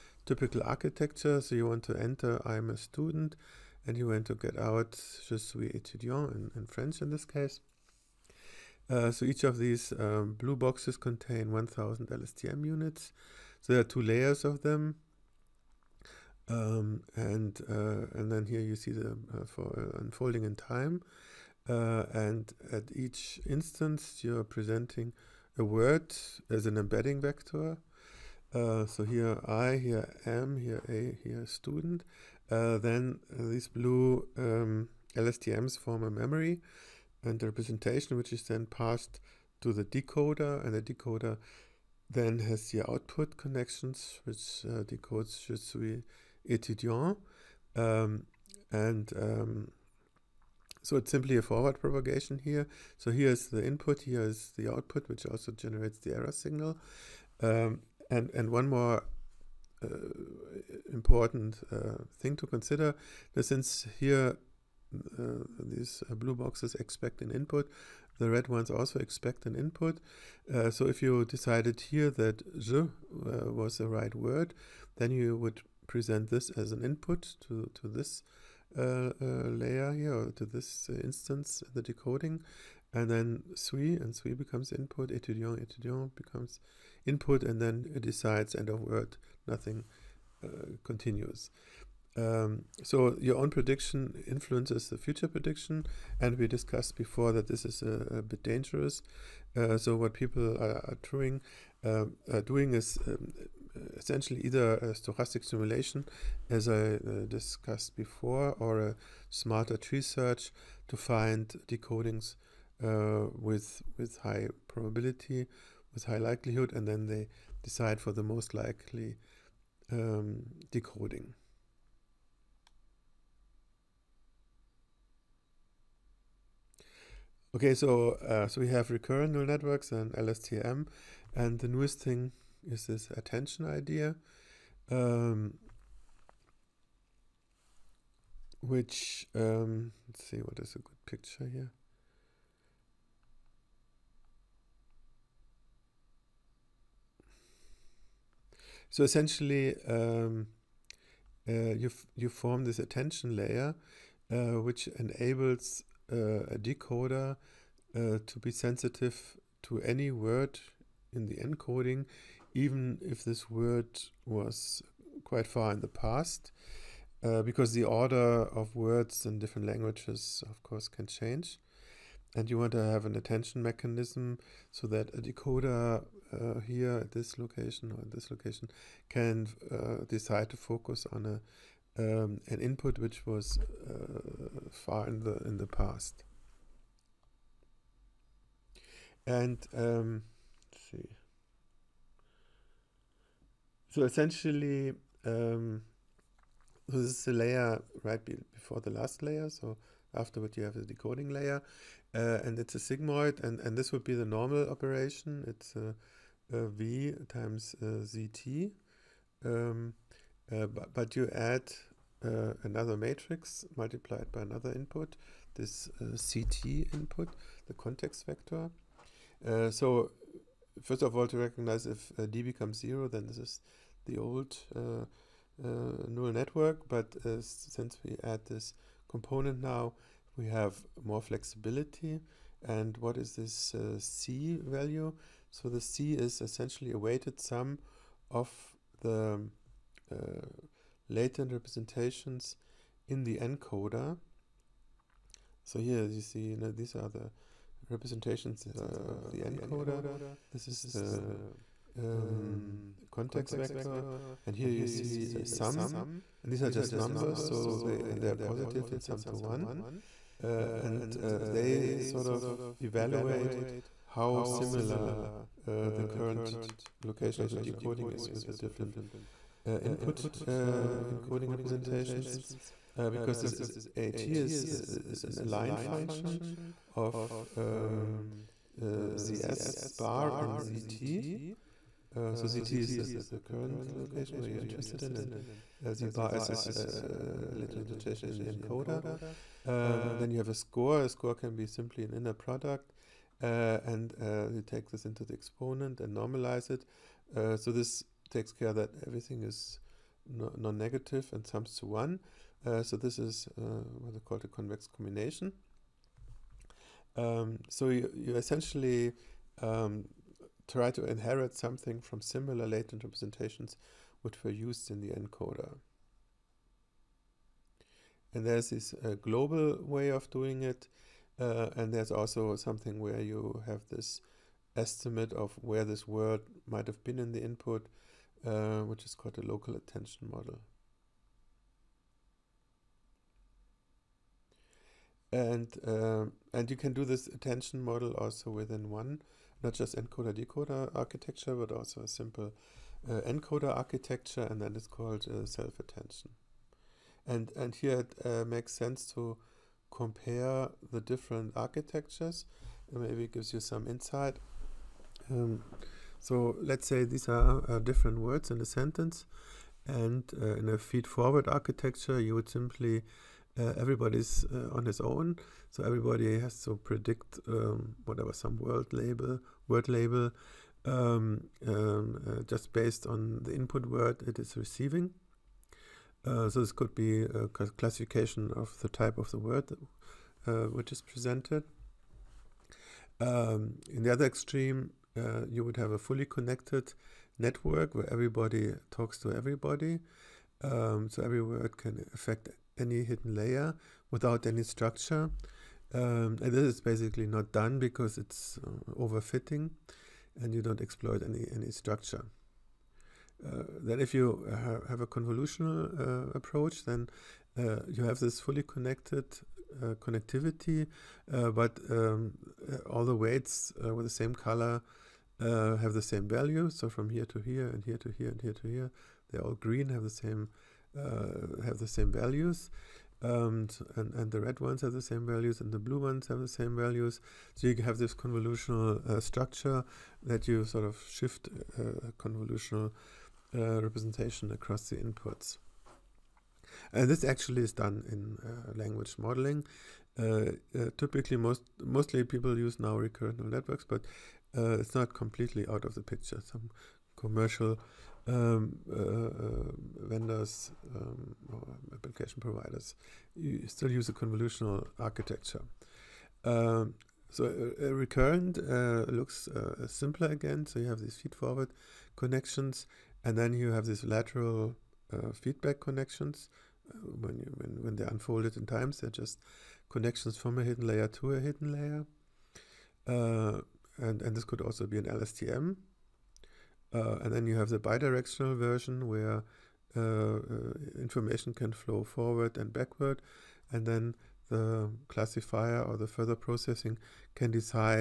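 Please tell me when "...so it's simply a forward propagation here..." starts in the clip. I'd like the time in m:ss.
0:50.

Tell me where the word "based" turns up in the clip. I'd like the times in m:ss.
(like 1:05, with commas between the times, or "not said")
6:12.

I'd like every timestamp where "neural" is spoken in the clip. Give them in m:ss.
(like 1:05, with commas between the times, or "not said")
2:09, 3:46, 7:23.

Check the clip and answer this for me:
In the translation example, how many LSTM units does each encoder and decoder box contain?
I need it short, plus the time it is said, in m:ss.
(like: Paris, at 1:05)
1000, at 0:11.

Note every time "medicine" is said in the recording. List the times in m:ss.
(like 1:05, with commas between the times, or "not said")
not said.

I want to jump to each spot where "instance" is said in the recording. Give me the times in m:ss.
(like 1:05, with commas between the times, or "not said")
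0:23, 1:21.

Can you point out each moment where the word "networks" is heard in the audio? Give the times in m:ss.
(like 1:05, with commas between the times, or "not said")
2:09, 3:46, 6:27, 7:23.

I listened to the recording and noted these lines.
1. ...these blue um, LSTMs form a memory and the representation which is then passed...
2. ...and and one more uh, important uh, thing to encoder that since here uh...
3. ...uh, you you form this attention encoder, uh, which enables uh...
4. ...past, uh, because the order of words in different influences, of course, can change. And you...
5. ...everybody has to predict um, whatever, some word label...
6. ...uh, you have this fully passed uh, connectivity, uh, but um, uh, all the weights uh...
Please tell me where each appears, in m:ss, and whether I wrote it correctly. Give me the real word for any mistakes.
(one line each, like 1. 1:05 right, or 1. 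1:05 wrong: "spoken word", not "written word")
1. 0:33 right
2. 0:58 wrong: "consider", not "encoder"
3. 2:31 wrong: "layer", not "encoder"
4. 2:45 wrong: "languages", not "influences"
5. 6:05 right
6. 6:47 wrong: "connected", not "passed".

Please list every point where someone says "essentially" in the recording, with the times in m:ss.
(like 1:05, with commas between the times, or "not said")
1:43, 2:29, 3:14, 3:56, 5:08.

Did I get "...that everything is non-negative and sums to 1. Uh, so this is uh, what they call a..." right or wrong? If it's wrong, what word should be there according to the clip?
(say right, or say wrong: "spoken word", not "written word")
right.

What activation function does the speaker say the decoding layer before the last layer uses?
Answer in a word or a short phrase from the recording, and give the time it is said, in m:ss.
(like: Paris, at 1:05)
sigmoid, at 3:22.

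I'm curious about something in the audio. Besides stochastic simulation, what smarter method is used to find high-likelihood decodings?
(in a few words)
tree search.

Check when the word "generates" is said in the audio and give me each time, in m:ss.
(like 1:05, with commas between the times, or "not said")
0:55.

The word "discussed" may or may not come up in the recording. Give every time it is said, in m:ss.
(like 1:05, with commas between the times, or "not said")
1:36, 1:47.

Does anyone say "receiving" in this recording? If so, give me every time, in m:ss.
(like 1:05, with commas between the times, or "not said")
6:14.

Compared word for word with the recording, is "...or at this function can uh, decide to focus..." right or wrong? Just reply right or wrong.
wrong.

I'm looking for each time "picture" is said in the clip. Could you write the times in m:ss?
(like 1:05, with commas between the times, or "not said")
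2:21, 7:26.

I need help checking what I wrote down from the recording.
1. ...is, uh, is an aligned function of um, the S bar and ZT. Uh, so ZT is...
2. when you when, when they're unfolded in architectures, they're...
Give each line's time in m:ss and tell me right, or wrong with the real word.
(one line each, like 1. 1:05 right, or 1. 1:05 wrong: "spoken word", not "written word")
1. 4:34 right
2. 7:47 wrong: "times", not "architectures".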